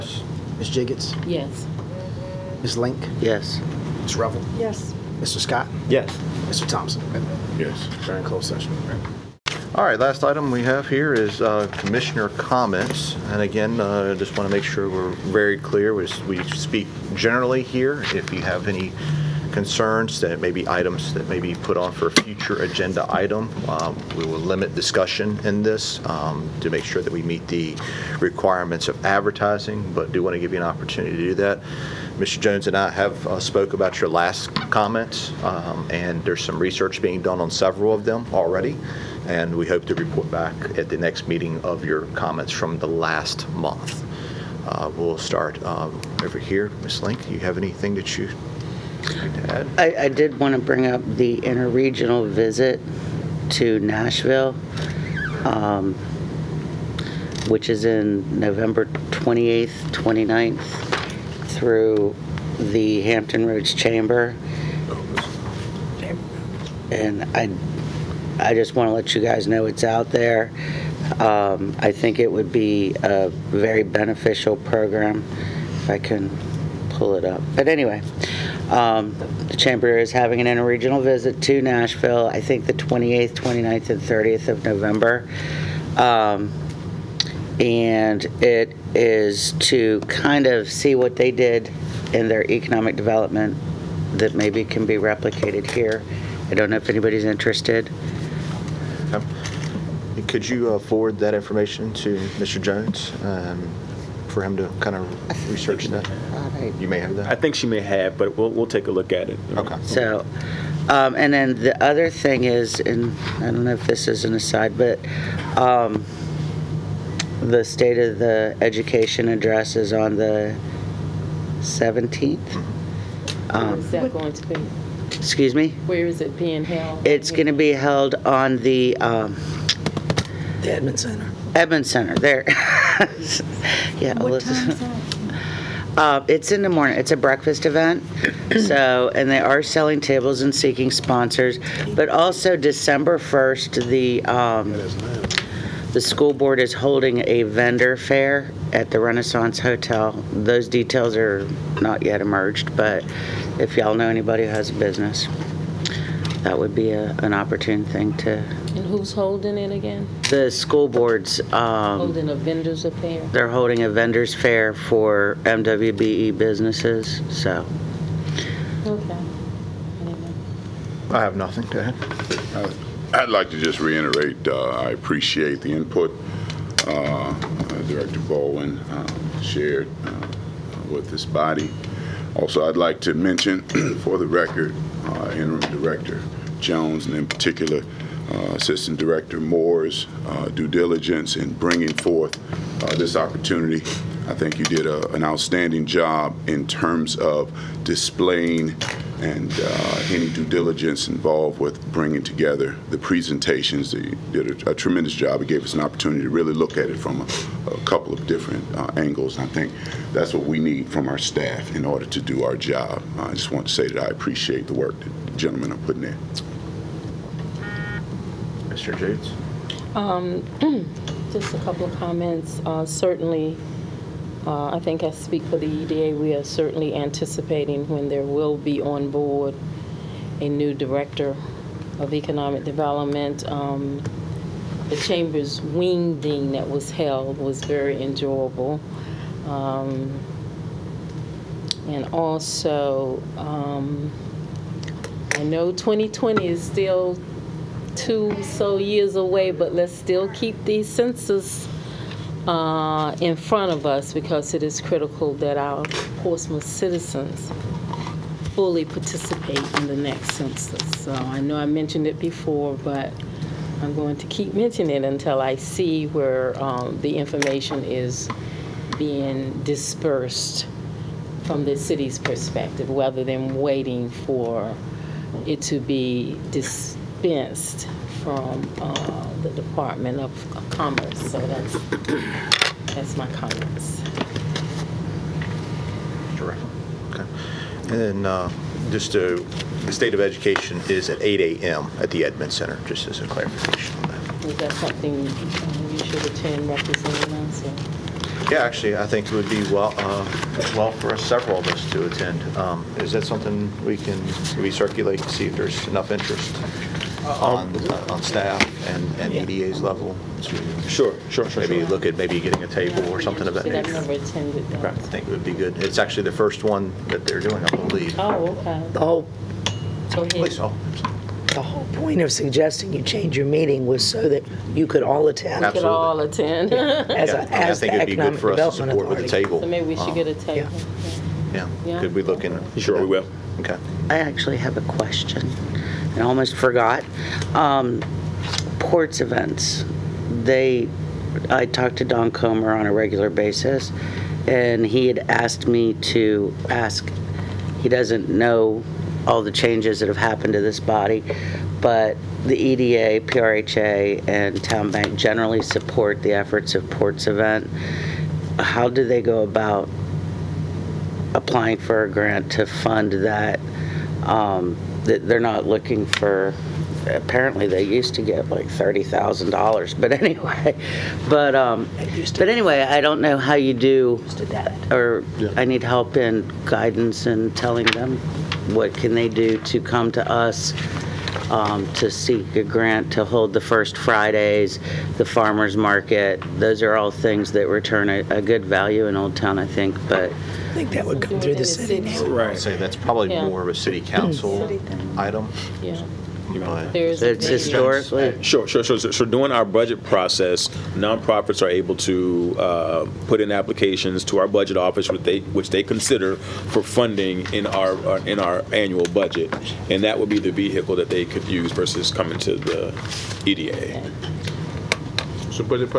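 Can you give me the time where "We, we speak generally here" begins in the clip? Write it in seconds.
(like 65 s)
15 s.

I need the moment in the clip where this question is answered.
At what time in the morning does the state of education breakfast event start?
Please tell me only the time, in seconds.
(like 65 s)
291 s.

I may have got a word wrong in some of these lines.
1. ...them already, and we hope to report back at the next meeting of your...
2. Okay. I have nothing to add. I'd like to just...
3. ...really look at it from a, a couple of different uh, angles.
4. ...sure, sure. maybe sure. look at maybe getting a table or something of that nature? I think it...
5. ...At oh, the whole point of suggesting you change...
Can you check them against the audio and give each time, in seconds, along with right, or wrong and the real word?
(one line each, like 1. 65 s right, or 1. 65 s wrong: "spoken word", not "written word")
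1. 38 s right
2. 168 s right
3. 206 s right
4. 311 s right
5. 320 s right.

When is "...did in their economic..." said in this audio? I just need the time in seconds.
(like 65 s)
91 s.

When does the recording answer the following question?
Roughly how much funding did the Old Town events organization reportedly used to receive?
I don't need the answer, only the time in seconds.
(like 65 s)
368 s.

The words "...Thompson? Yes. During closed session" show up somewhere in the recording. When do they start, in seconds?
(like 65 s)
6 s.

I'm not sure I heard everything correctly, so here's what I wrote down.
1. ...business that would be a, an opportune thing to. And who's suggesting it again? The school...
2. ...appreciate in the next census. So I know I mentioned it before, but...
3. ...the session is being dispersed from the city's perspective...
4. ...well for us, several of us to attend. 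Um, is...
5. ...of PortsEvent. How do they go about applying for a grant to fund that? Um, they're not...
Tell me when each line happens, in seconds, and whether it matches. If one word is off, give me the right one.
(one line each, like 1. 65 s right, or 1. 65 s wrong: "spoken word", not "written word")
1. 154 s wrong: "holding", not "suggesting"
2. 258 s wrong: "participate", not "appreciate"
3. 267 s wrong: "information", not "session"
4. 300 s right
5. 356 s right.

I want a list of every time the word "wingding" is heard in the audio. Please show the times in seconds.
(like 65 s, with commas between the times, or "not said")
235 s.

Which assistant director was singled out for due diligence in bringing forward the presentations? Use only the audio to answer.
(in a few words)
Moore.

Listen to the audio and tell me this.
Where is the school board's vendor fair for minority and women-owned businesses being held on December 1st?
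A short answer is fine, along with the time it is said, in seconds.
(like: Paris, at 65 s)
Renaissance Hotel, at 149 s.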